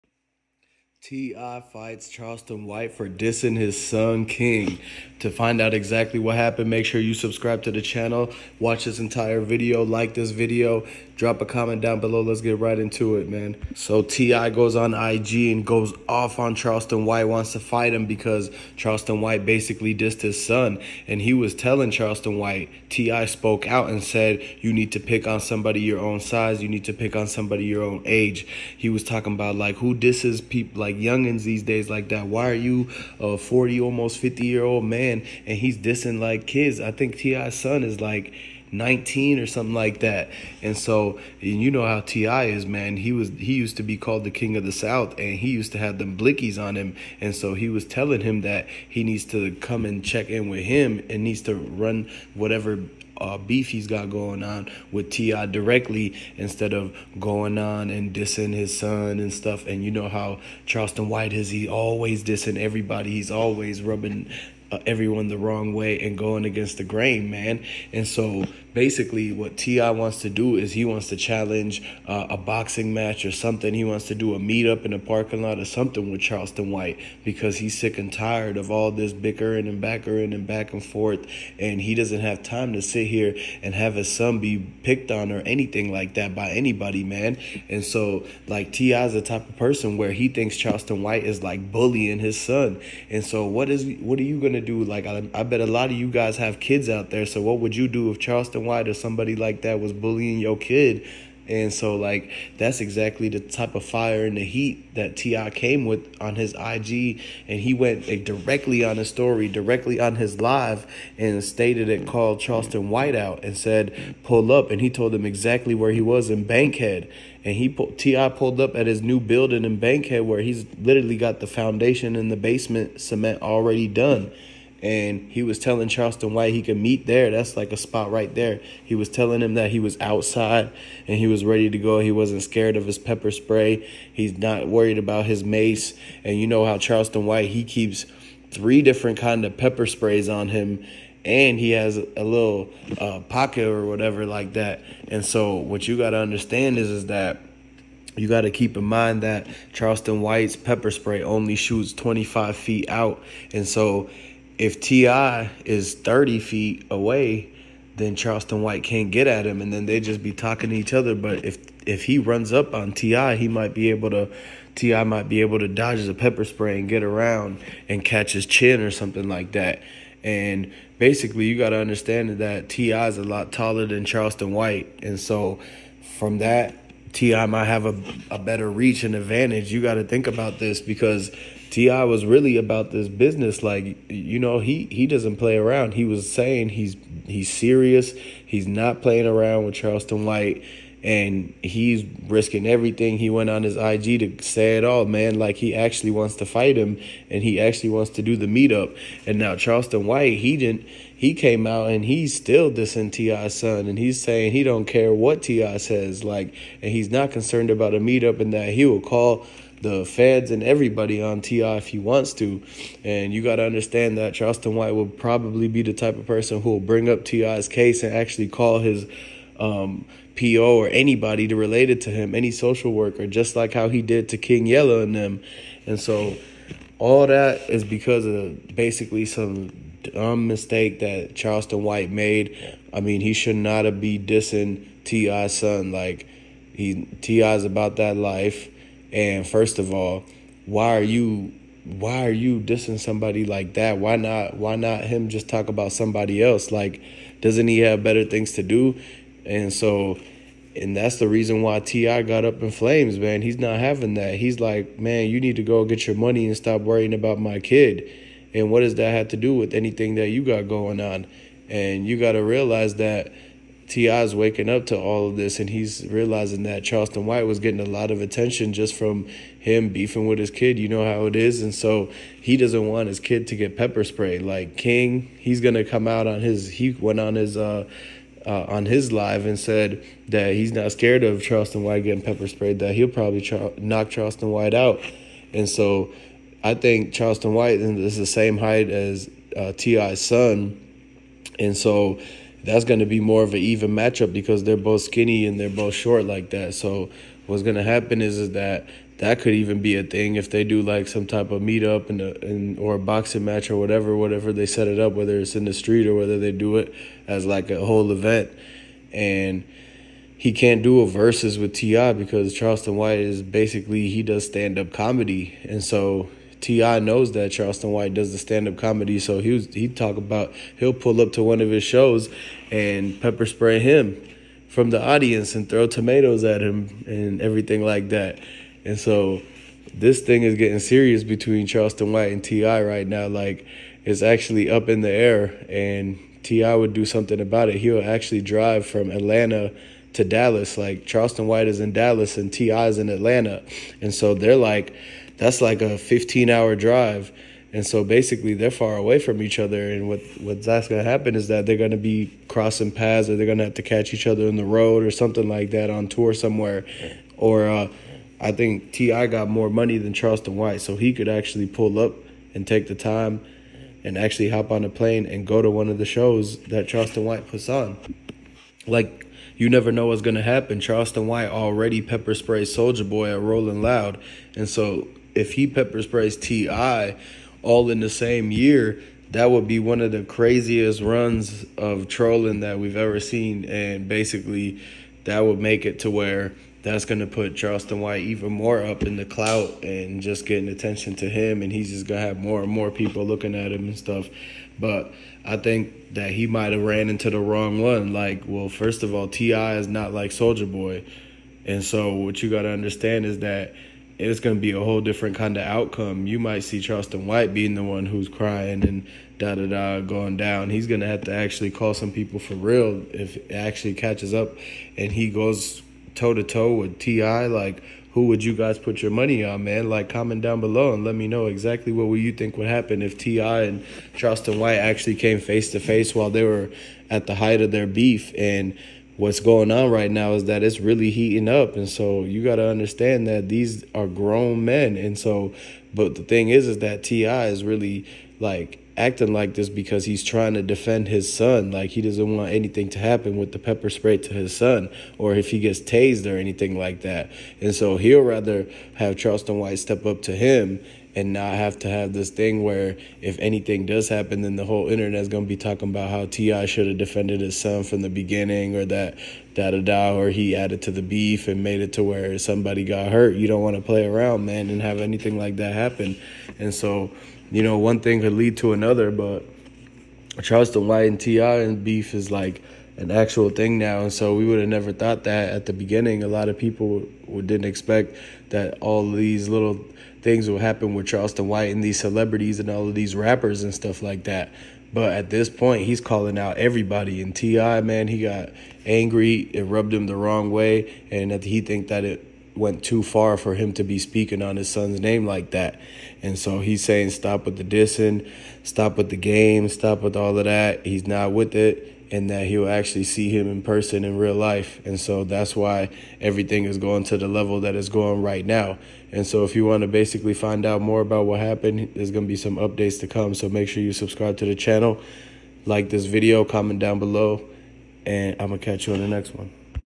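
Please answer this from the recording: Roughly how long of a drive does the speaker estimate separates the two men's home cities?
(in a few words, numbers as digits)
15 hours.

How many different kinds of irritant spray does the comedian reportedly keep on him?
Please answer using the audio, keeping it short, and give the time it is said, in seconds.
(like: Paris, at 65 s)
3, at 138 s.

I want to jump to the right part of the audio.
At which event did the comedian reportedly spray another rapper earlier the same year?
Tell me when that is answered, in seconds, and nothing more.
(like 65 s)
373 s.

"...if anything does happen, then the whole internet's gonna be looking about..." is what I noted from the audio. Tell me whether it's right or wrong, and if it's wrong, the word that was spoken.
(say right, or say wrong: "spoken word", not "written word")
wrong: "talking", not "looking".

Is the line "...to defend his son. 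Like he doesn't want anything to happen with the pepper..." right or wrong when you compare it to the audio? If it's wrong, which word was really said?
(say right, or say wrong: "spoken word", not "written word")
right.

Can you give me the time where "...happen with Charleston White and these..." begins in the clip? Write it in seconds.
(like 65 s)
480 s.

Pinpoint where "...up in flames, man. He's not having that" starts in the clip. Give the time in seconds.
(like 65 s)
252 s.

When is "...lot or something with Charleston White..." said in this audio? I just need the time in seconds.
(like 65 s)
75 s.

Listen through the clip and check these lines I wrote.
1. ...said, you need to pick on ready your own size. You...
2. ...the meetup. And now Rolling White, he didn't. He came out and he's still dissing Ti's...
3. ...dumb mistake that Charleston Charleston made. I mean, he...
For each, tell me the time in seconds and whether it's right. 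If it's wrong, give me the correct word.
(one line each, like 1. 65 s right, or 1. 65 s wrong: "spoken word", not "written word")
1. 24 s wrong: "somebody", not "ready"
2. 198 s wrong: "Charleston", not "Rolling"
3. 230 s wrong: "White", not "Charleston".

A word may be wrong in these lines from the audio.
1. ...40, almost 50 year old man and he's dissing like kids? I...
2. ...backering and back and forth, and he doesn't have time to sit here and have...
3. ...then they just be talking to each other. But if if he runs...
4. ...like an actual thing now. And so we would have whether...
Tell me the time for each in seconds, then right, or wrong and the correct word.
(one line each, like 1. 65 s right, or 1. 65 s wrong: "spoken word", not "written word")
1. 33 s right
2. 79 s right
3. 159 s right
4. 472 s wrong: "never", not "whether".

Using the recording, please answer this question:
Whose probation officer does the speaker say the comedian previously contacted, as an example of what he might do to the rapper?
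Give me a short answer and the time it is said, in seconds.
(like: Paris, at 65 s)
King Yella, at 224 s.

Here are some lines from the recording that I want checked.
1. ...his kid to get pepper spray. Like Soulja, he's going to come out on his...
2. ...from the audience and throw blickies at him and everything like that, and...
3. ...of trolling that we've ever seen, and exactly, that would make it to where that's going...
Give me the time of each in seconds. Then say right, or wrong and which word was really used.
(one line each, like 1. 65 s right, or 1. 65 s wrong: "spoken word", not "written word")
1. 273 s wrong: "King", not "Soulja"
2. 324 s wrong: "tomatoes", not "blickies"
3. 381 s wrong: "basically", not "exactly".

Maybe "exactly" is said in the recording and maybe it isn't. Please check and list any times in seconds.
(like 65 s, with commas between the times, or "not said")
5 s, 102 s, 115 s, 421 s.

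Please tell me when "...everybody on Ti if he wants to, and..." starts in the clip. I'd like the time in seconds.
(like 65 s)
210 s.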